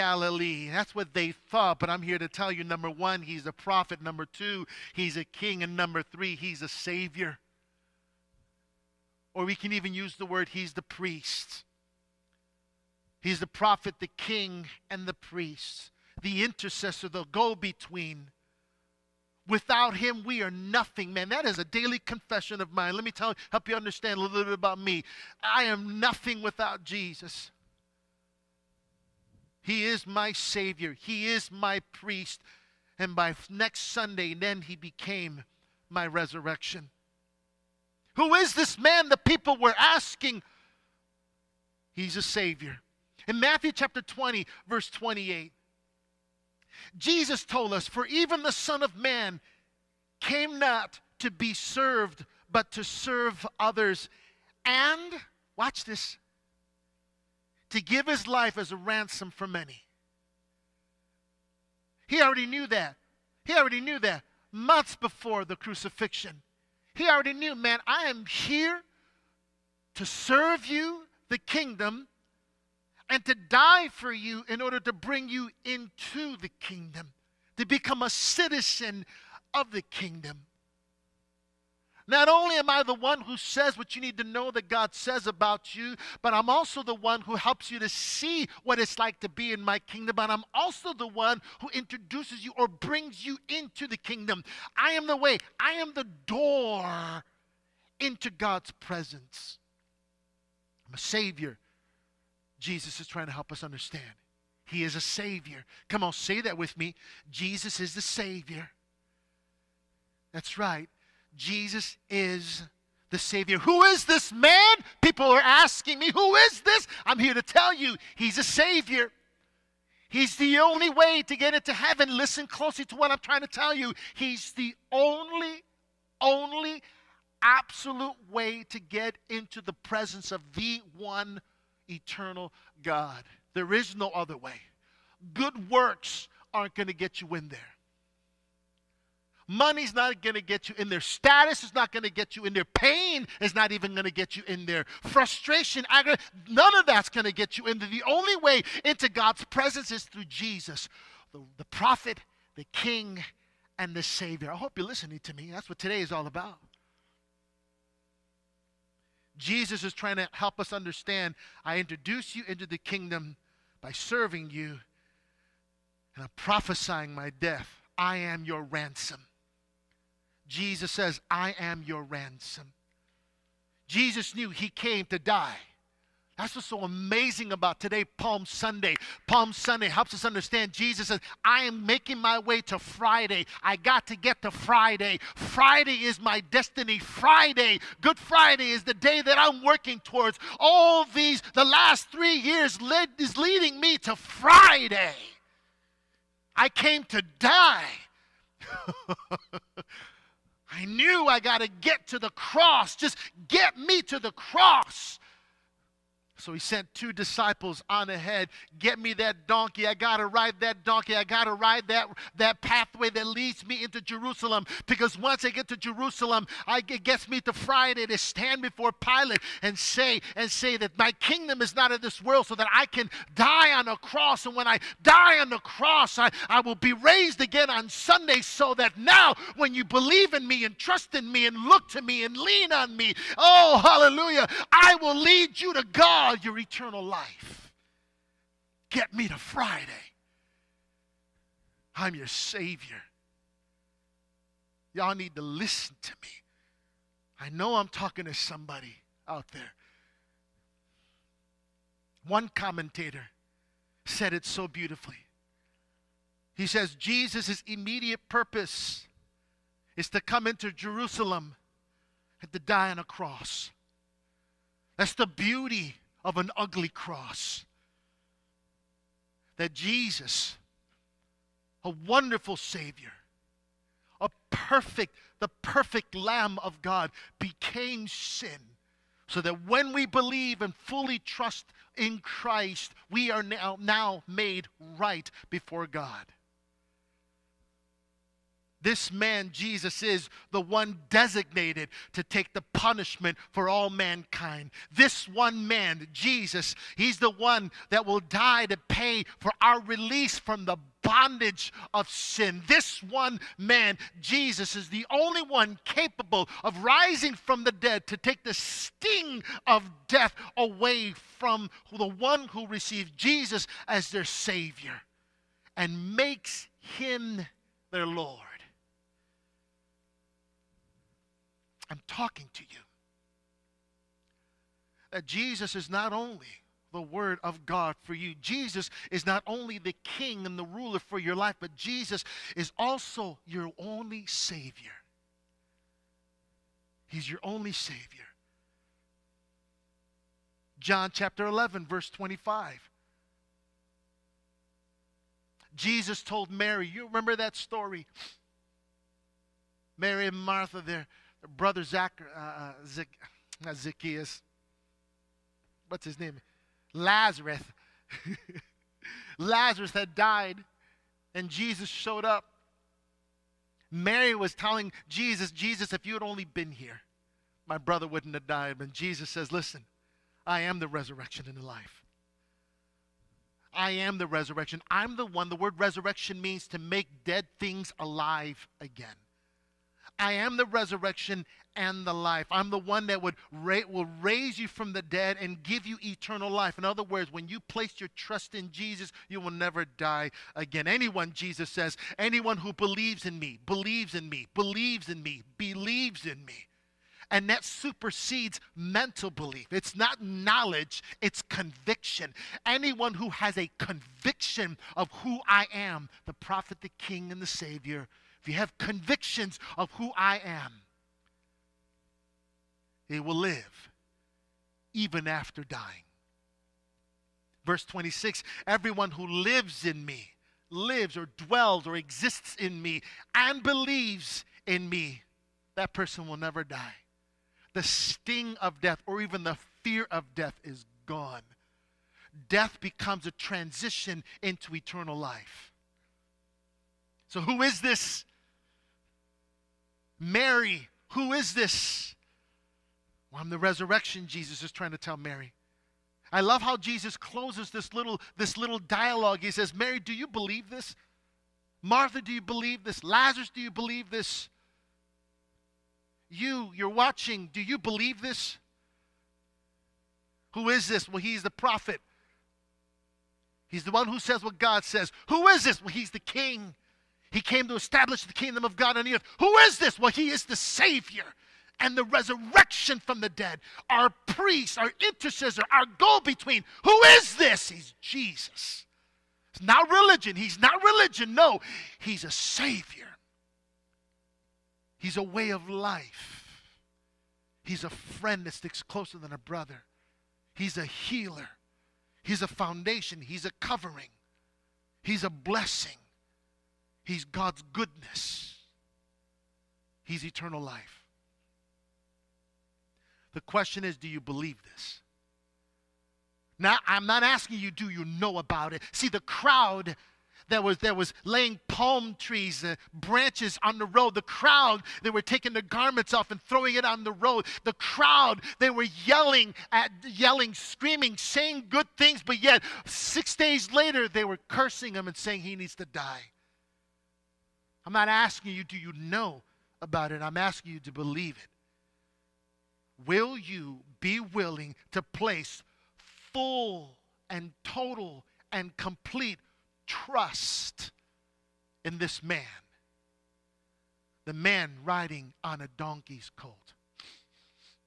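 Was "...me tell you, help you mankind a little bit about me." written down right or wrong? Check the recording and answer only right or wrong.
wrong.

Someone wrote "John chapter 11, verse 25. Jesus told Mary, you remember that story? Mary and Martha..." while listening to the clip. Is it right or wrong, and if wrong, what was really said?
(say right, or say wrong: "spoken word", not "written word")
right.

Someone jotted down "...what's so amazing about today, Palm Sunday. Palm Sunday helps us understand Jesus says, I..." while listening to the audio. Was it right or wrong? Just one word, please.
right.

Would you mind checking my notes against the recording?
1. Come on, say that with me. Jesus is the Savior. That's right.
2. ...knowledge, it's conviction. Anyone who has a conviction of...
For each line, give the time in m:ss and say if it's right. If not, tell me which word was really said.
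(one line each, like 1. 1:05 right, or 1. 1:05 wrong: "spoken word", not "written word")
1. 1:45 right
2. 6:40 right.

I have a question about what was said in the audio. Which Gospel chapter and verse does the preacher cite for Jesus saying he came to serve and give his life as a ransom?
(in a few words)
Matthew 20:28.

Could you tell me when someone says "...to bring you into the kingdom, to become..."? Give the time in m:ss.
1:14.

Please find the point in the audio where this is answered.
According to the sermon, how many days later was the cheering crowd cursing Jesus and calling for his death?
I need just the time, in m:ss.
8:42.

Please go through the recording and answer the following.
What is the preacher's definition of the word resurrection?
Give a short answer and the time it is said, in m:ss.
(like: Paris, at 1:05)
To make dead things alive again, at 6:16.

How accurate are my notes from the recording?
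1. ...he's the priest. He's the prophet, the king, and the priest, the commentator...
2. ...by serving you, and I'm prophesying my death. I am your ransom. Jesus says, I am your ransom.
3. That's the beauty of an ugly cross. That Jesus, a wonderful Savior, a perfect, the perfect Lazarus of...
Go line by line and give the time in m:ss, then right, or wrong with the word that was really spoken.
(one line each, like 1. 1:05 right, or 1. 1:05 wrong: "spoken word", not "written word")
1. 0:10 wrong: "intercessor", not "commentator"
2. 2:43 right
3. 4:24 wrong: "Lamb", not "Lazarus".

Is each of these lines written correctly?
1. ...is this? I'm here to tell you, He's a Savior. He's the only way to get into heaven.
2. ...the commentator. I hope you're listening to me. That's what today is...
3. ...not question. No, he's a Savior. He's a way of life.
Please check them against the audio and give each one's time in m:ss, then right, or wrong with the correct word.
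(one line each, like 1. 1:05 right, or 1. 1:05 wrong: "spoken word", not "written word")
1. 1:56 right
2. 2:33 wrong: "savior", not "commentator"
3. 8:00 wrong: "religion", not "question".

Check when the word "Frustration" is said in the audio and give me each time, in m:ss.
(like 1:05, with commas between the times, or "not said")
2:25.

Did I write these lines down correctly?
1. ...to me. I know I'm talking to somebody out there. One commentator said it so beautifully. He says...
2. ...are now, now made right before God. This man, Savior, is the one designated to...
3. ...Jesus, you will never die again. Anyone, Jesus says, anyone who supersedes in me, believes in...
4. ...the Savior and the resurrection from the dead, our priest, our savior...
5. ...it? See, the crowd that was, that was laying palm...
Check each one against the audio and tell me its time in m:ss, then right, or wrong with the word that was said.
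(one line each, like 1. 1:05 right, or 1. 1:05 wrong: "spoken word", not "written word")
1. 4:06 right
2. 4:43 wrong: "Jesus", not "Savior"
3. 6:28 wrong: "believes", not "supersedes"
4. 7:50 wrong: "intercessor", not "savior"
5. 8:28 right.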